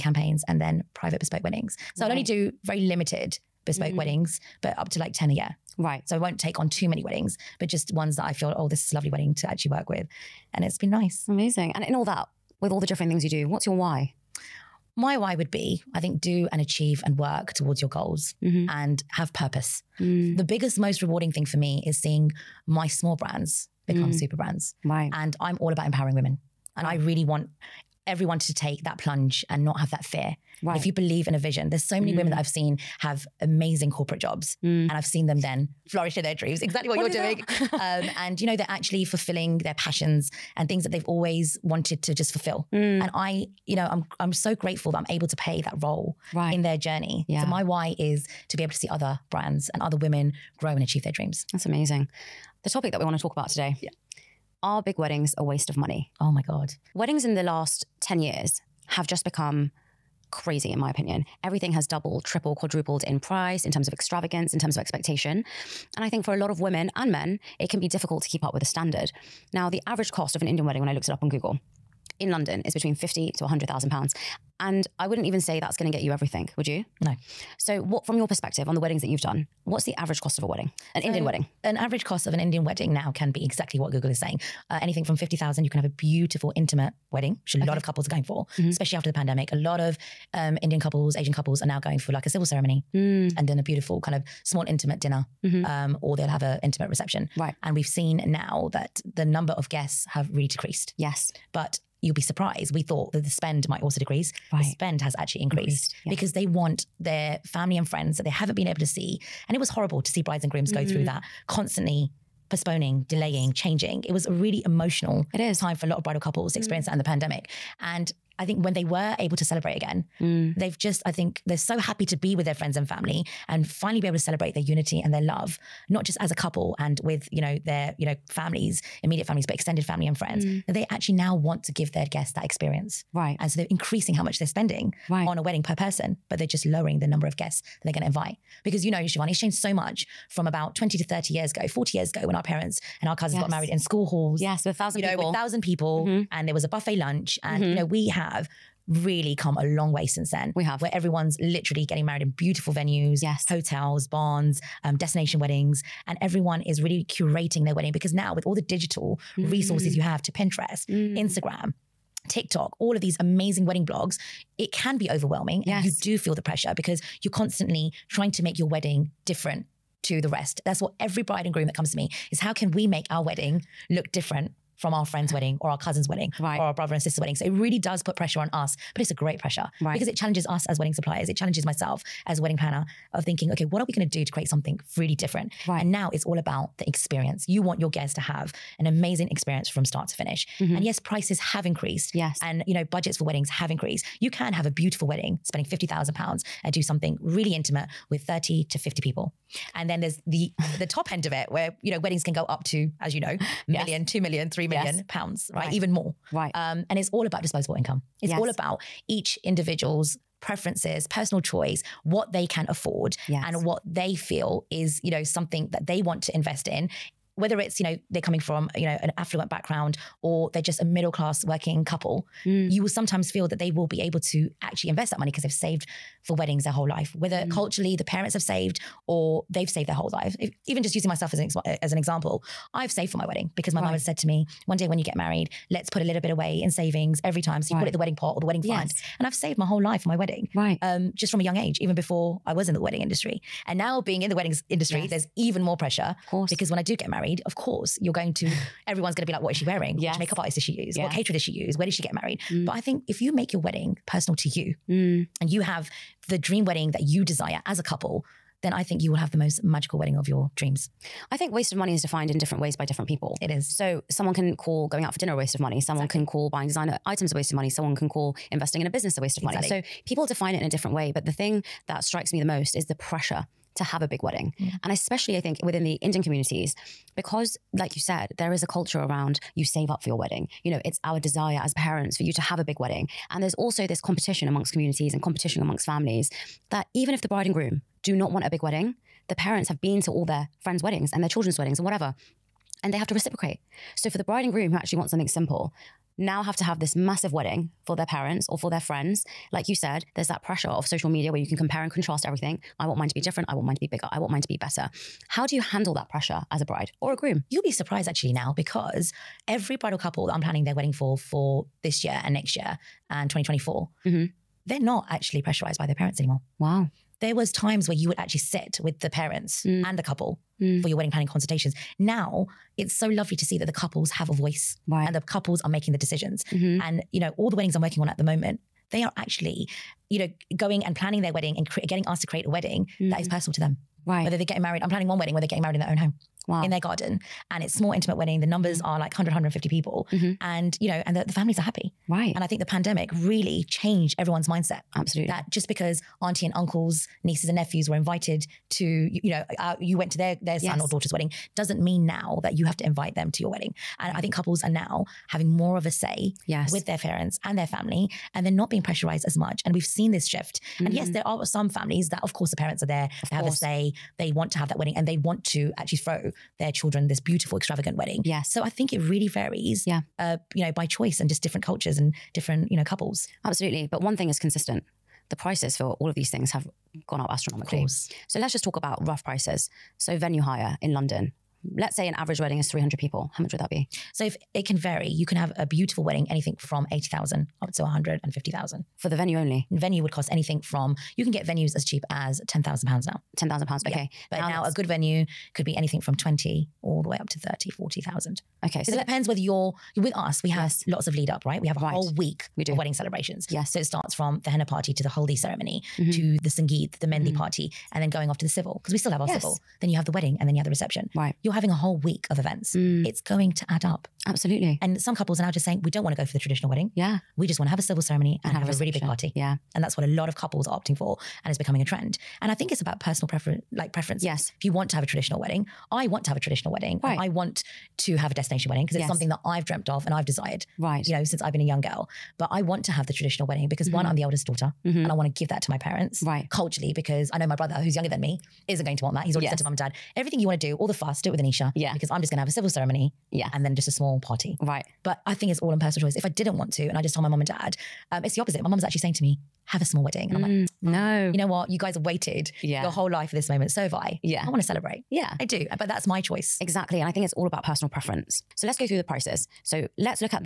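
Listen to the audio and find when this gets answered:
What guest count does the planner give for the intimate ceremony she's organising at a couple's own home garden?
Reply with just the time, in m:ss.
5:39.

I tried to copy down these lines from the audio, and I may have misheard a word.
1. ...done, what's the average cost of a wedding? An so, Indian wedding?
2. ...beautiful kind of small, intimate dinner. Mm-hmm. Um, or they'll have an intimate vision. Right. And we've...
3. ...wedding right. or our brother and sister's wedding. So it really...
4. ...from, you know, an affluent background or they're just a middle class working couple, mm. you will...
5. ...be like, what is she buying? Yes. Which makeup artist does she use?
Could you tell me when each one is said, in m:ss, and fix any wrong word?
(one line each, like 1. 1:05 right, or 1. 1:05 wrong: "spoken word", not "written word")
1. 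1:19 right
2. 1:33 wrong: "reception", not "vision"
3. 2:56 right
4. 3:38 right
5. 4:09 wrong: "wearing", not "buying".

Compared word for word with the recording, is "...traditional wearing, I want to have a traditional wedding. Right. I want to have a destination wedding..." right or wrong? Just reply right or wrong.
wrong.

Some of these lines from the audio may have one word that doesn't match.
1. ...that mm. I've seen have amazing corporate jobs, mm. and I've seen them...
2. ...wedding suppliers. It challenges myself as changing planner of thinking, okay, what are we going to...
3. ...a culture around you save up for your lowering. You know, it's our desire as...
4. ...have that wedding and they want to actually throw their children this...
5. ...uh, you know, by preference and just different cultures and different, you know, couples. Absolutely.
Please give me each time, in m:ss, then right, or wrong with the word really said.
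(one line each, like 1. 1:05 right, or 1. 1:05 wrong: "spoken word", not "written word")
1. 0:32 right
2. 3:00 wrong: "wedding", not "changing"
3. 4:38 wrong: "wedding", not "lowering"
4. 6:04 right
5. 6:10 wrong: "choice", not "preference".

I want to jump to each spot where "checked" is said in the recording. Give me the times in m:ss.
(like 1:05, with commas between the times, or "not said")
not said.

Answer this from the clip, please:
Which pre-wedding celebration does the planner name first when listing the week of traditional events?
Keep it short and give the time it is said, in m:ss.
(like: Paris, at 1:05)
henna party, at 6:44.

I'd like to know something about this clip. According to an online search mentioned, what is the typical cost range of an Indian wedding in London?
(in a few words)
£50,000 to £100,000.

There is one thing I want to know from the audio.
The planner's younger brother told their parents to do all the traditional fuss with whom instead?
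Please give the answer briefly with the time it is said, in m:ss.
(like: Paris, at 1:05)
Anisha, at 7:21.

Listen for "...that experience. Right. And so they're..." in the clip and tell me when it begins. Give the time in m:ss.
2:12.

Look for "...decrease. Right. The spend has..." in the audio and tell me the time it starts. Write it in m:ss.
1:43.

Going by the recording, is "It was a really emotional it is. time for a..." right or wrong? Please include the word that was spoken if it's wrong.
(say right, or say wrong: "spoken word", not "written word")
right.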